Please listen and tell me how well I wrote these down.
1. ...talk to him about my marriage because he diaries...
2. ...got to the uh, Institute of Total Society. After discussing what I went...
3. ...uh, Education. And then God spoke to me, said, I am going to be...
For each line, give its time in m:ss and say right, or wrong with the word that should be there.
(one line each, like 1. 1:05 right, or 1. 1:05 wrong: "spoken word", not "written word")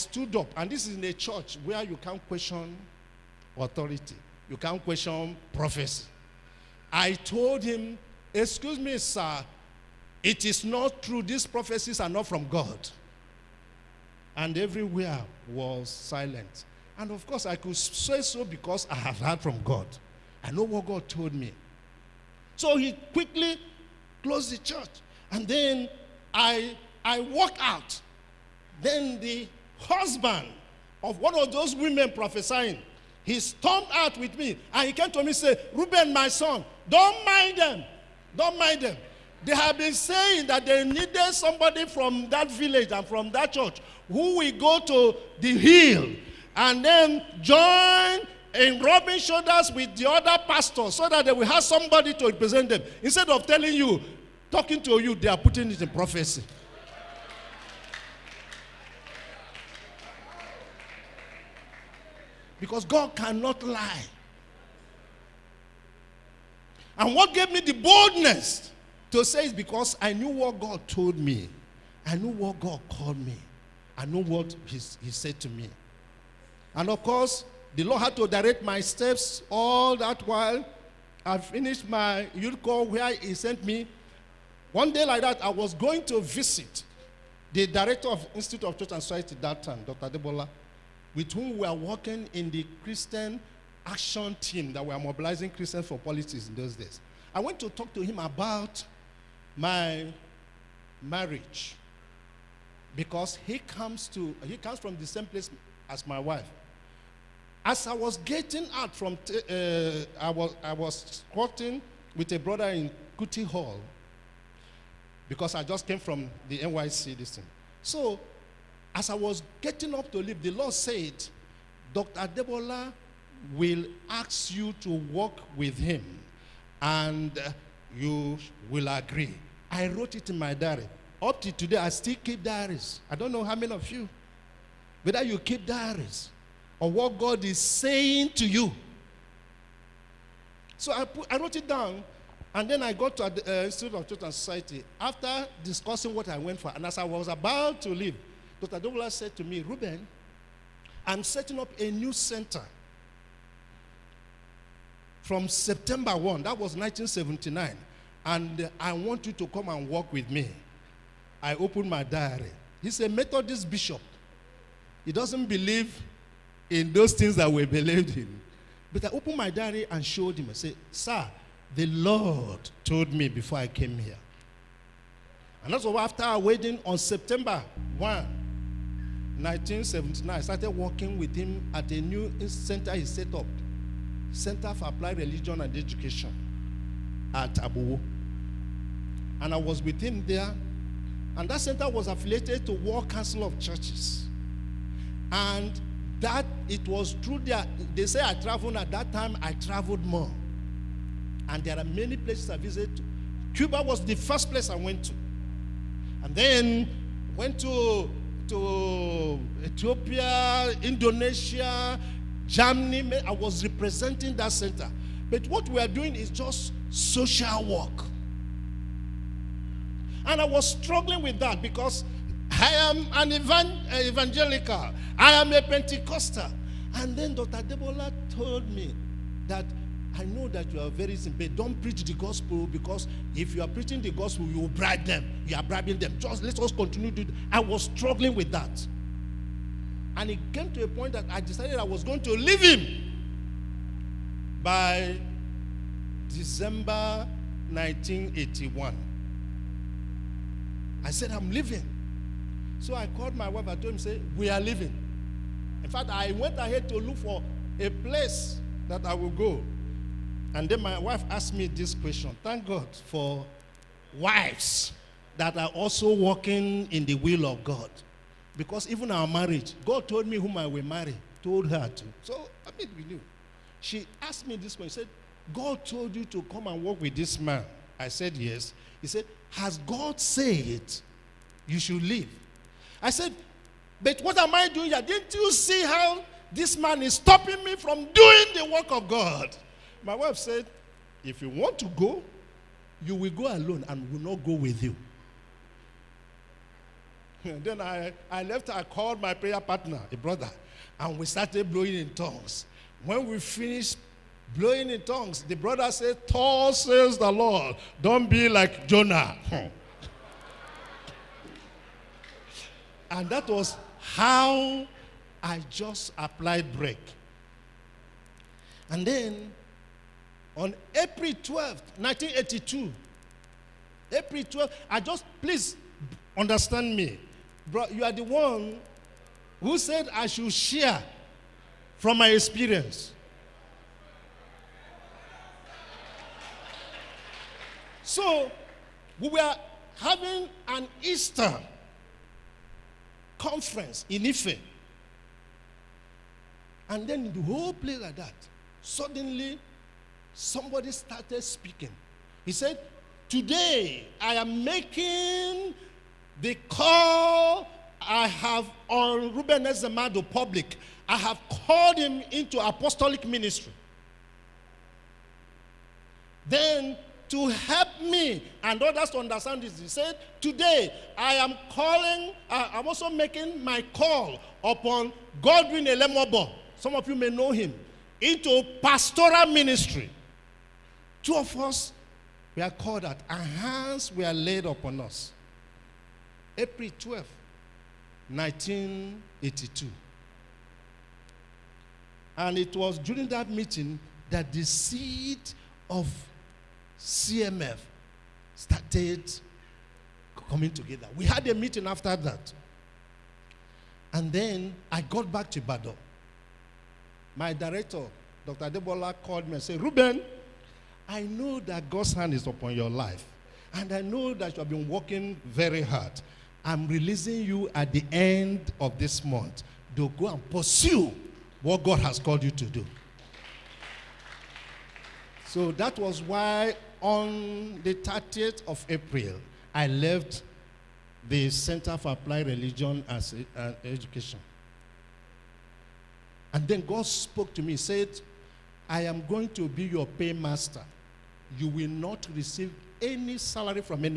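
1. 1:37 wrong: "comes", not "diaries"
2. 2:22 right
3. 7:13 right.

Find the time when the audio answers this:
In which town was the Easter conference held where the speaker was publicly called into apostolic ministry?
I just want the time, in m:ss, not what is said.
5:44.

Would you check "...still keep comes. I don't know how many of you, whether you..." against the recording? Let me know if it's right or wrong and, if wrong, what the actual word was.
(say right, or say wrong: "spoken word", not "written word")
wrong: "diaries", not "comes".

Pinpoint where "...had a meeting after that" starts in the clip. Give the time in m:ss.
6:41.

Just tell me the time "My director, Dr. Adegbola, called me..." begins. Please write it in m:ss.
6:47.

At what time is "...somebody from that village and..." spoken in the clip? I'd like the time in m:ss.
0:41.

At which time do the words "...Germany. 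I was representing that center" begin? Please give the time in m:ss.
3:32.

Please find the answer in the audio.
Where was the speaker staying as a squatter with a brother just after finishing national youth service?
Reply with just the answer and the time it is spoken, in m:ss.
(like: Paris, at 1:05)
Kuti Hall, at 1:53.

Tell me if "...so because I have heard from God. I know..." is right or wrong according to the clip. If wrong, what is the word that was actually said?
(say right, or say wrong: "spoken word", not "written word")
right.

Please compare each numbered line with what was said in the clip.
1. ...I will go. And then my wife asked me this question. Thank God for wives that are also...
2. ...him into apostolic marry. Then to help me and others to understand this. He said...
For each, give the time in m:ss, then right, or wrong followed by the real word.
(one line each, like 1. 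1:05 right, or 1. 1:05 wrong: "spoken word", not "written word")
1. 4:19 right
2. 6:01 wrong: "ministry", not "marry".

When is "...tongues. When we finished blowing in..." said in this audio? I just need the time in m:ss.
5:02.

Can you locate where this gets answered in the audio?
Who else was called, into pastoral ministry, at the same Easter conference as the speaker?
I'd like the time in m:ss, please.
6:15.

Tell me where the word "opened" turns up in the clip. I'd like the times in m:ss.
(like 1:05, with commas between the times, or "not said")
2:41, 2:49.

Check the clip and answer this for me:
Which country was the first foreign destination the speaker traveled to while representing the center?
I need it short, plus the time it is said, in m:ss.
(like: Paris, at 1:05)
Cuba, at 3:23.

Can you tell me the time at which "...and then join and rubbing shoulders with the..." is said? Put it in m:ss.
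0:46.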